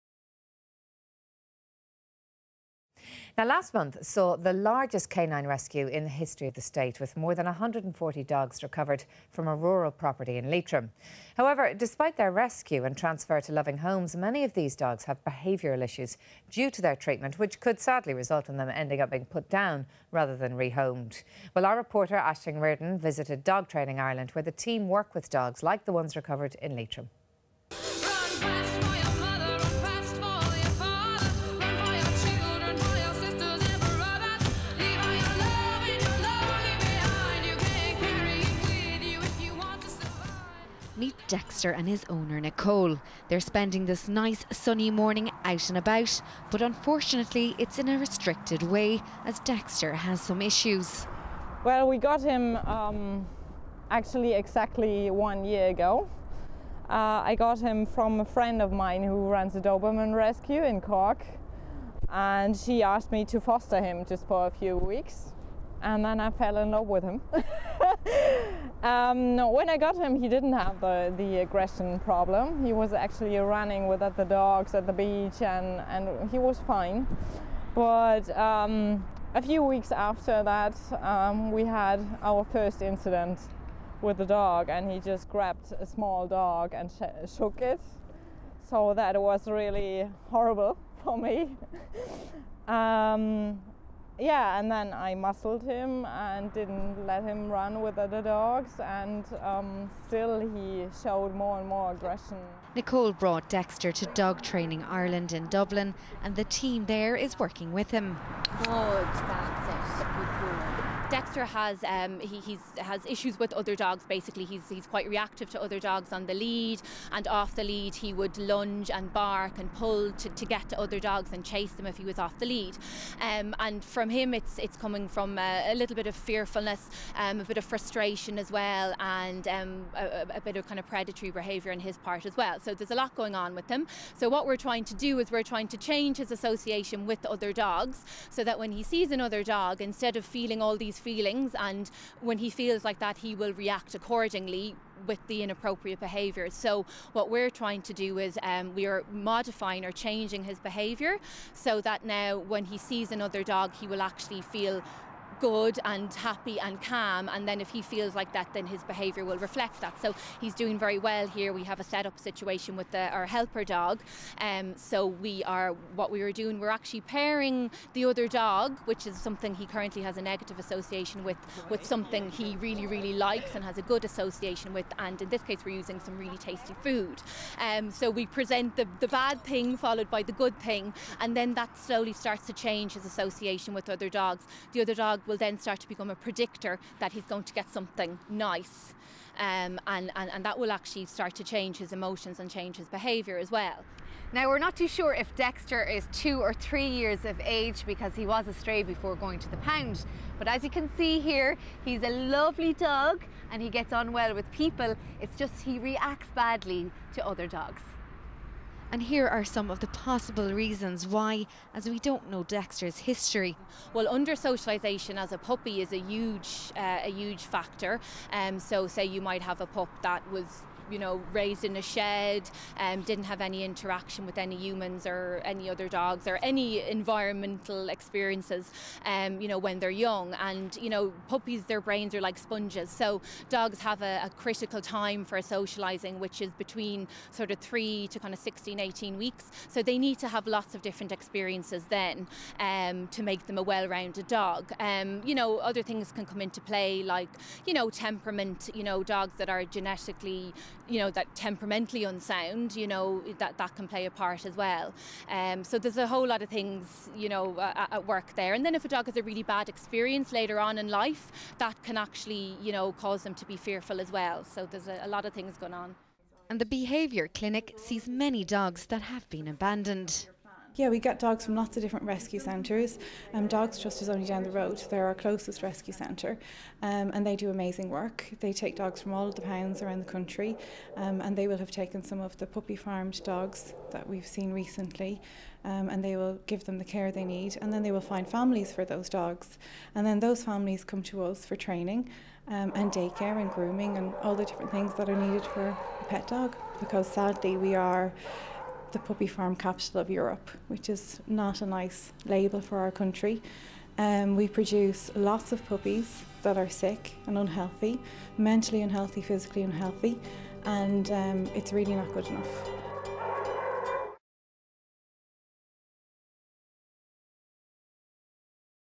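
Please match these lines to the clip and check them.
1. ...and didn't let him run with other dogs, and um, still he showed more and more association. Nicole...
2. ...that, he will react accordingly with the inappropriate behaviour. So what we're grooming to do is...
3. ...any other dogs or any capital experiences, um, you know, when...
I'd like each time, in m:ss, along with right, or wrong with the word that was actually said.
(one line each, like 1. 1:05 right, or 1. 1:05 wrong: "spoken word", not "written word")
1. 1:36 wrong: "aggression", not "association"
2. 2:22 wrong: "trying", not "grooming"
3. 3:45 wrong: "environmental", not "capital".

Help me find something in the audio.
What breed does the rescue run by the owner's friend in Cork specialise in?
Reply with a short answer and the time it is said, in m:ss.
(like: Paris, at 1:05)
Doberman, at 0:59.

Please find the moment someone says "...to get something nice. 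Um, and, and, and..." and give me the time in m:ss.
3:07.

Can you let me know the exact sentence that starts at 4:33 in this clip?
Um, dogs Trust is only down the road.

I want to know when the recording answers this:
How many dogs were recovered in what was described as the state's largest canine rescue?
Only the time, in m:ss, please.
0:07.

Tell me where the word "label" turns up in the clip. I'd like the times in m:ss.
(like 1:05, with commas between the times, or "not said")
5:02.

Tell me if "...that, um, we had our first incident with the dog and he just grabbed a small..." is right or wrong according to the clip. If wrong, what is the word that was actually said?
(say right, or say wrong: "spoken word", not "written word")
right.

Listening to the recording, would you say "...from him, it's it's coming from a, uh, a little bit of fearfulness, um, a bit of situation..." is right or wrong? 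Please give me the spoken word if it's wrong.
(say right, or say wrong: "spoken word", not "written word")
wrong: "frustration", not "situation".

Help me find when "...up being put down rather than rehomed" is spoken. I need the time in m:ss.
0:18.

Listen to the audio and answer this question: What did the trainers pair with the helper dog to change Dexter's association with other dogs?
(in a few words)
tasty food.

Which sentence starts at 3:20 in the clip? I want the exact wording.
But as you can see here, he's a lovely dog and he gets on well with people.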